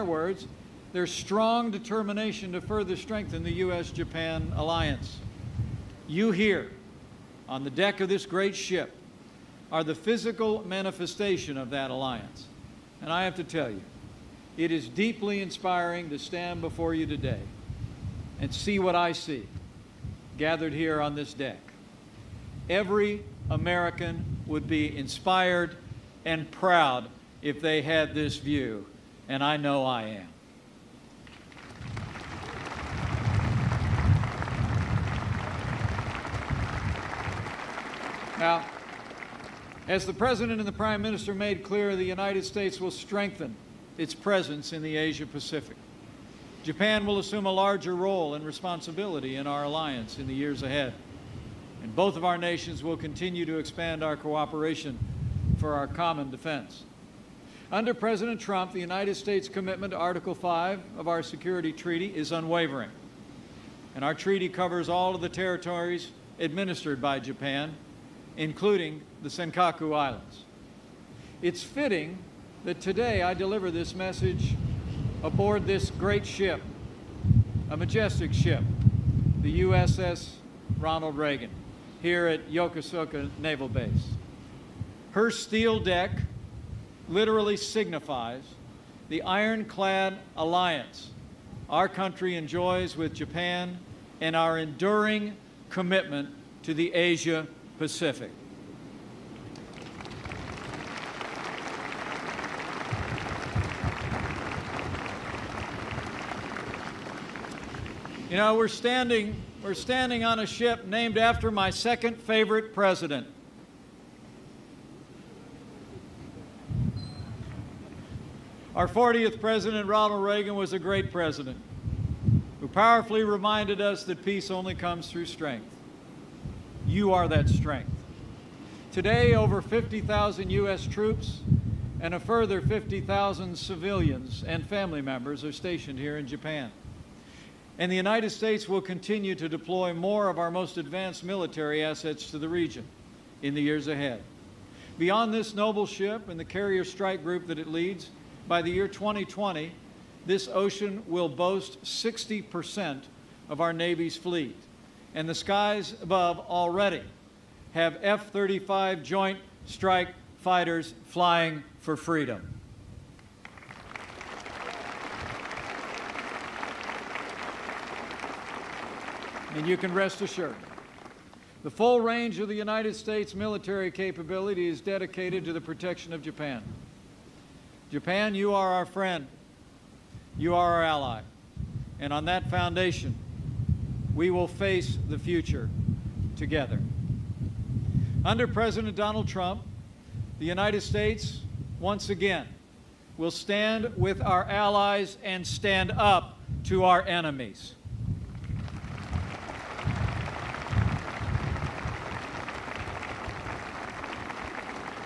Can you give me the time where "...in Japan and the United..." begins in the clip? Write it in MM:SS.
02:16.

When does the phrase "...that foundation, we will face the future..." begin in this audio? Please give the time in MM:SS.
03:02.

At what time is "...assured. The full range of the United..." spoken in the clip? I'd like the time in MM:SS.
02:50.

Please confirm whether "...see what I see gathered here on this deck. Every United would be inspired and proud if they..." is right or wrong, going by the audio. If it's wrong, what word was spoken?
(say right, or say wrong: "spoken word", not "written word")
wrong: "American", not "United".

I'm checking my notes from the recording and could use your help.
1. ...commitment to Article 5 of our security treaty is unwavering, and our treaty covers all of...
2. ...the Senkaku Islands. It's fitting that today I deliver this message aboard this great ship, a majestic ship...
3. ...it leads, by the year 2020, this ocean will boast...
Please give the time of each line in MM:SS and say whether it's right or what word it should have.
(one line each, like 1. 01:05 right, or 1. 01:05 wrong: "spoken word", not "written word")
1. 00:59 right
2. 01:09 right
3. 02:27 right.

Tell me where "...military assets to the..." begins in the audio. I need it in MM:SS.
02:21.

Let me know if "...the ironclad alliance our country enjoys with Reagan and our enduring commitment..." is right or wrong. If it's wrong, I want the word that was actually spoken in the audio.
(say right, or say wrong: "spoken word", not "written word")
wrong: "Japan", not "Reagan".